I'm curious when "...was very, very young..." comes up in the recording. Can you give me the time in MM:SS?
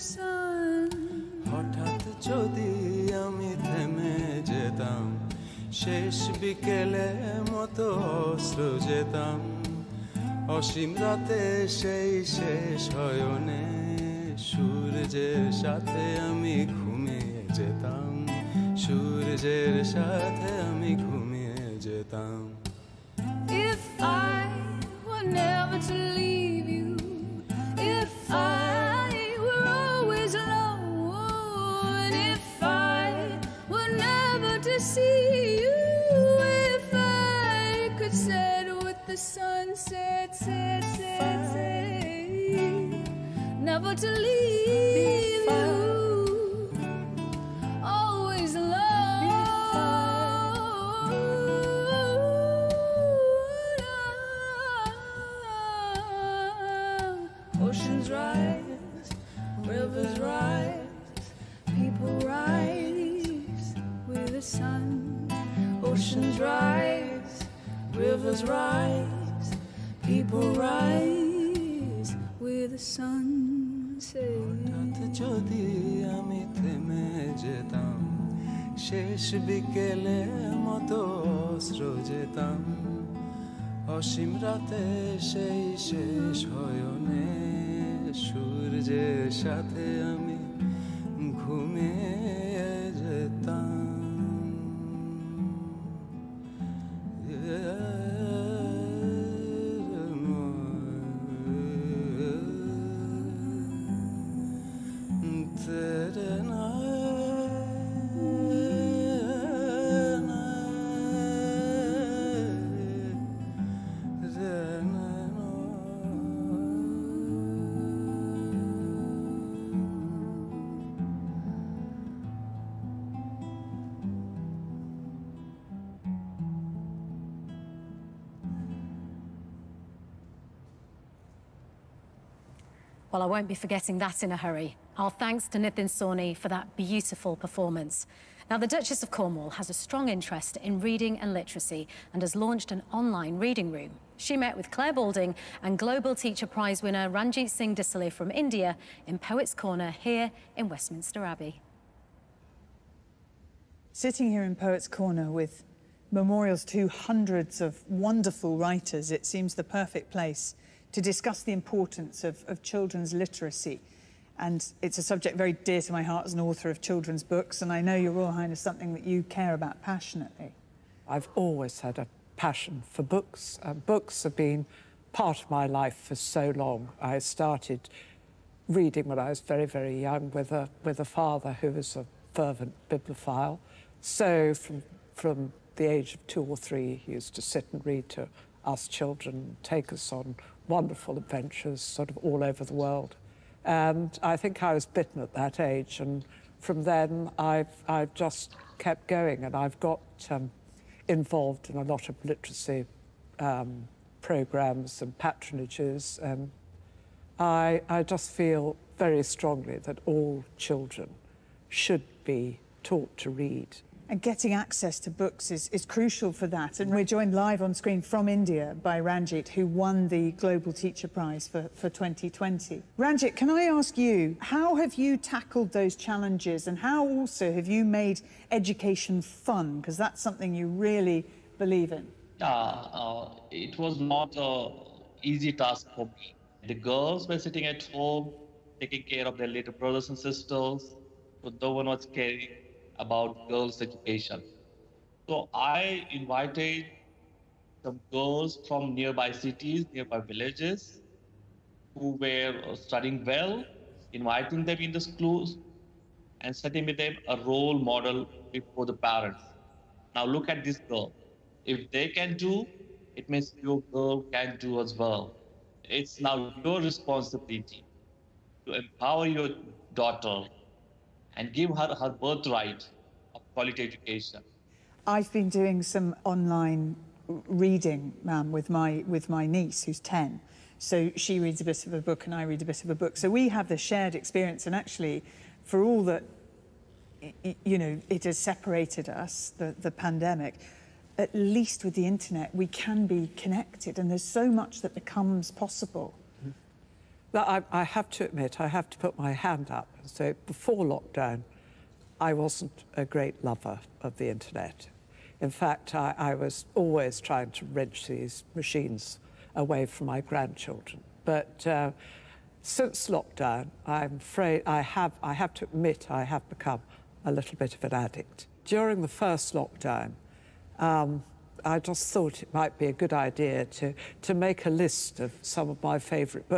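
02:59.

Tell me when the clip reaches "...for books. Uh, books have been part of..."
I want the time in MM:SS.
02:52.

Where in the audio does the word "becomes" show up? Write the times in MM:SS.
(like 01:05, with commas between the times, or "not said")
04:54, 05:16.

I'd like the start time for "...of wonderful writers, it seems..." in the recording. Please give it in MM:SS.
02:37.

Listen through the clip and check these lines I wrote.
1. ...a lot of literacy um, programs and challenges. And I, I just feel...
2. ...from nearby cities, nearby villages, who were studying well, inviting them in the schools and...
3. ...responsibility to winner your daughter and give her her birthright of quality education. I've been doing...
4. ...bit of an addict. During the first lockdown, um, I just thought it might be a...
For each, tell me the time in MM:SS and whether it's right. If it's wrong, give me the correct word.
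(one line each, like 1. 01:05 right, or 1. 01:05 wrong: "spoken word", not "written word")
1. 03:21 wrong: "patronages", not "challenges"
2. 04:08 right
3. 04:26 wrong: "empower", not "winner"
4. 05:17 right.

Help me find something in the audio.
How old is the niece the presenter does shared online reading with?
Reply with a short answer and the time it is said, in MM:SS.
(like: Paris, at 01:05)
10, at 04:39.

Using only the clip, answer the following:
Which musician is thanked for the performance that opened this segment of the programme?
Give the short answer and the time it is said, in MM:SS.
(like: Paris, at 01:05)
Nitin Sawhney, at 02:15.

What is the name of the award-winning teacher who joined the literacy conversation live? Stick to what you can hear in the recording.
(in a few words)
Ranjit Singh Disale.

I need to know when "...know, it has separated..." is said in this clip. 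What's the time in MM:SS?
04:47.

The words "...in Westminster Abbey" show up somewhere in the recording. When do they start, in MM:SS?
02:30.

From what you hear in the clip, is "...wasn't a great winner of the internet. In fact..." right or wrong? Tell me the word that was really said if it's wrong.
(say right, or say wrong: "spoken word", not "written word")
wrong: "lover", not "winner".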